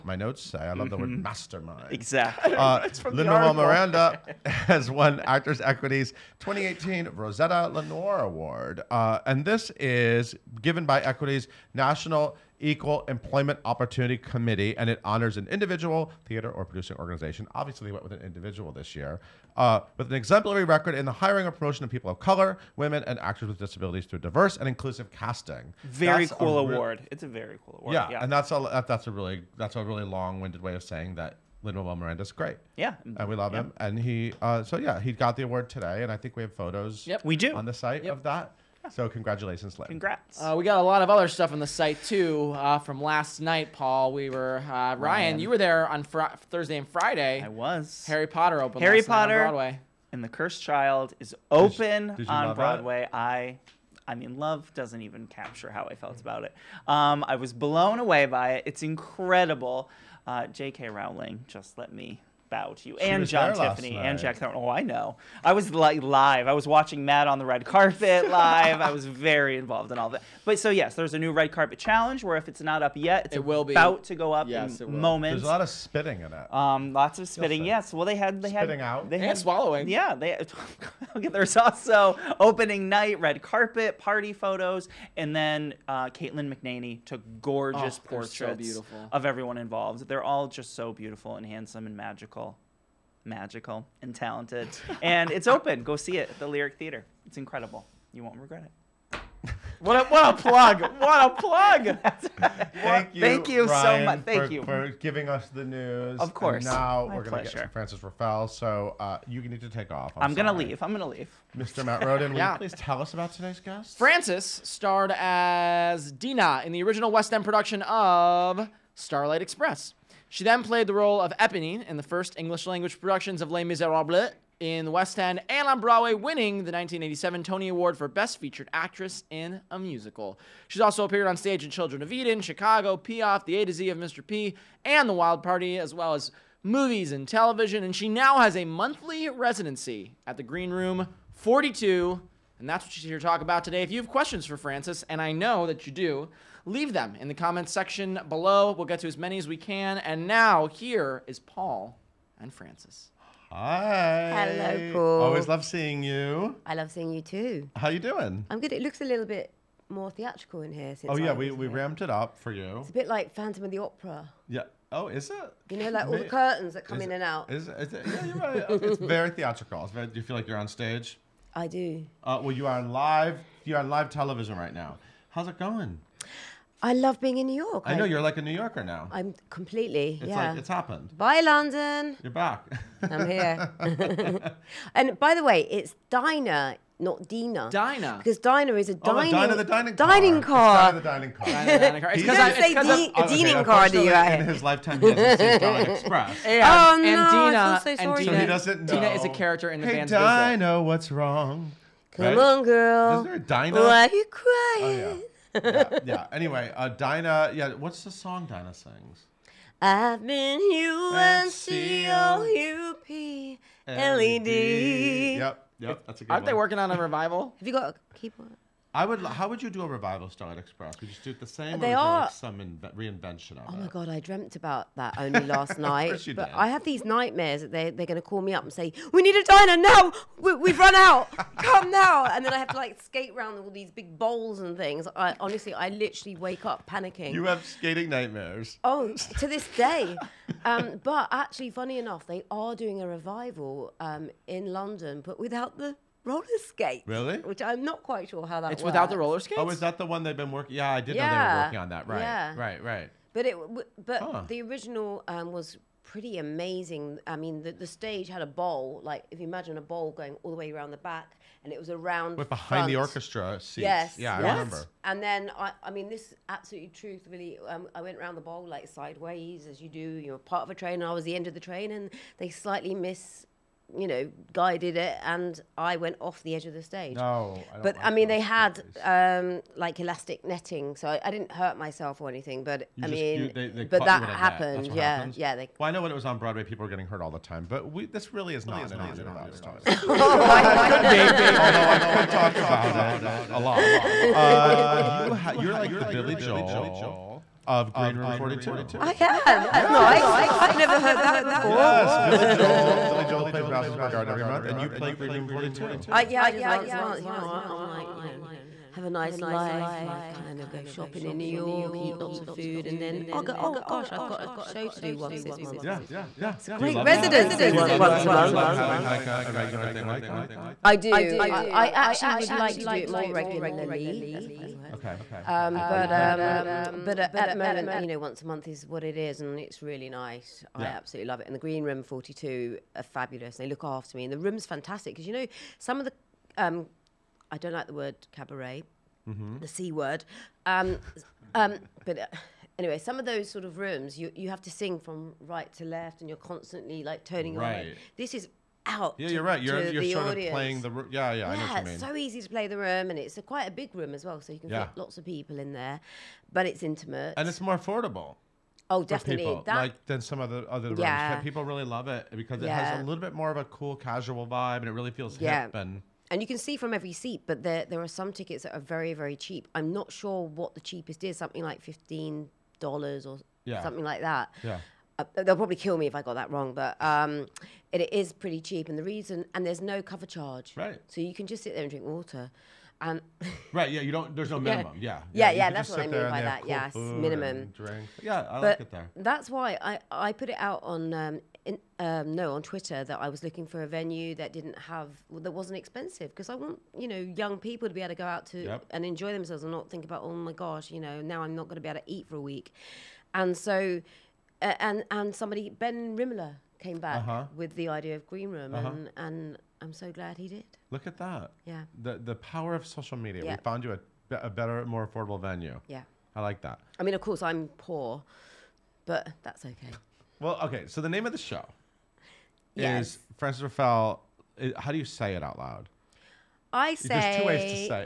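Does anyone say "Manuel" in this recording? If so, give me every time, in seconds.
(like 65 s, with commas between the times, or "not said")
3 s, 31 s.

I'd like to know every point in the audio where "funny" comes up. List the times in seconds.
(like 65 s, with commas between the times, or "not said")
241 s, 324 s.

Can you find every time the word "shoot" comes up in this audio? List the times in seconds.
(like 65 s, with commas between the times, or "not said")
not said.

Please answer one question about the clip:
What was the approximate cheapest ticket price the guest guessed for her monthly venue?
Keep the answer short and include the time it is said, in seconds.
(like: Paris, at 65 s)
$15, at 371 s.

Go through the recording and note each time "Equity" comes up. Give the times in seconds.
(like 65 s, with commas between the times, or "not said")
5 s, 11 s.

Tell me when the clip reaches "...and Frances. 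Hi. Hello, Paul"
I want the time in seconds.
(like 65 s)
152 s.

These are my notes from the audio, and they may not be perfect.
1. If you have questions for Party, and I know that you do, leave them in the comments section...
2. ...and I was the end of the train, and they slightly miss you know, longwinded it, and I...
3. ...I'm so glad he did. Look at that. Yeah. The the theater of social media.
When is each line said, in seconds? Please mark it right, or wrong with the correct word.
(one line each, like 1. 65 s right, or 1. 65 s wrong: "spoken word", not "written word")
1. 143 s wrong: "Frances", not "Party"
2. 270 s wrong: "guided", not "longwinded"
3. 409 s wrong: "power", not "theater".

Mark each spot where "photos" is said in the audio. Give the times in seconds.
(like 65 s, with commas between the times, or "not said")
36 s, 84 s.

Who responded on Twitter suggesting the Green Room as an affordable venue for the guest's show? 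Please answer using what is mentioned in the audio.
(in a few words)
Ben Rimalower.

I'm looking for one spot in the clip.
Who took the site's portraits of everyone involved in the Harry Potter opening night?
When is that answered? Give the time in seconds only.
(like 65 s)
86 s.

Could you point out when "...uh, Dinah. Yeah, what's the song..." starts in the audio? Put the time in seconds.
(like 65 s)
206 s.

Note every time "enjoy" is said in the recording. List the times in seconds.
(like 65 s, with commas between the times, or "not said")
399 s.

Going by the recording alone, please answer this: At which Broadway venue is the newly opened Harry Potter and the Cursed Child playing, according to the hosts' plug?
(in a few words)
Lyric Theater.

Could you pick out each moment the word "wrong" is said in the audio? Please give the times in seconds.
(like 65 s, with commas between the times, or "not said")
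201 s, 376 s.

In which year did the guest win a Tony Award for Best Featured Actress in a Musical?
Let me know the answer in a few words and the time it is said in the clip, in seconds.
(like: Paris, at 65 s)
1987, at 126 s.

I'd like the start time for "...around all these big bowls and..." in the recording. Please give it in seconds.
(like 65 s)
233 s.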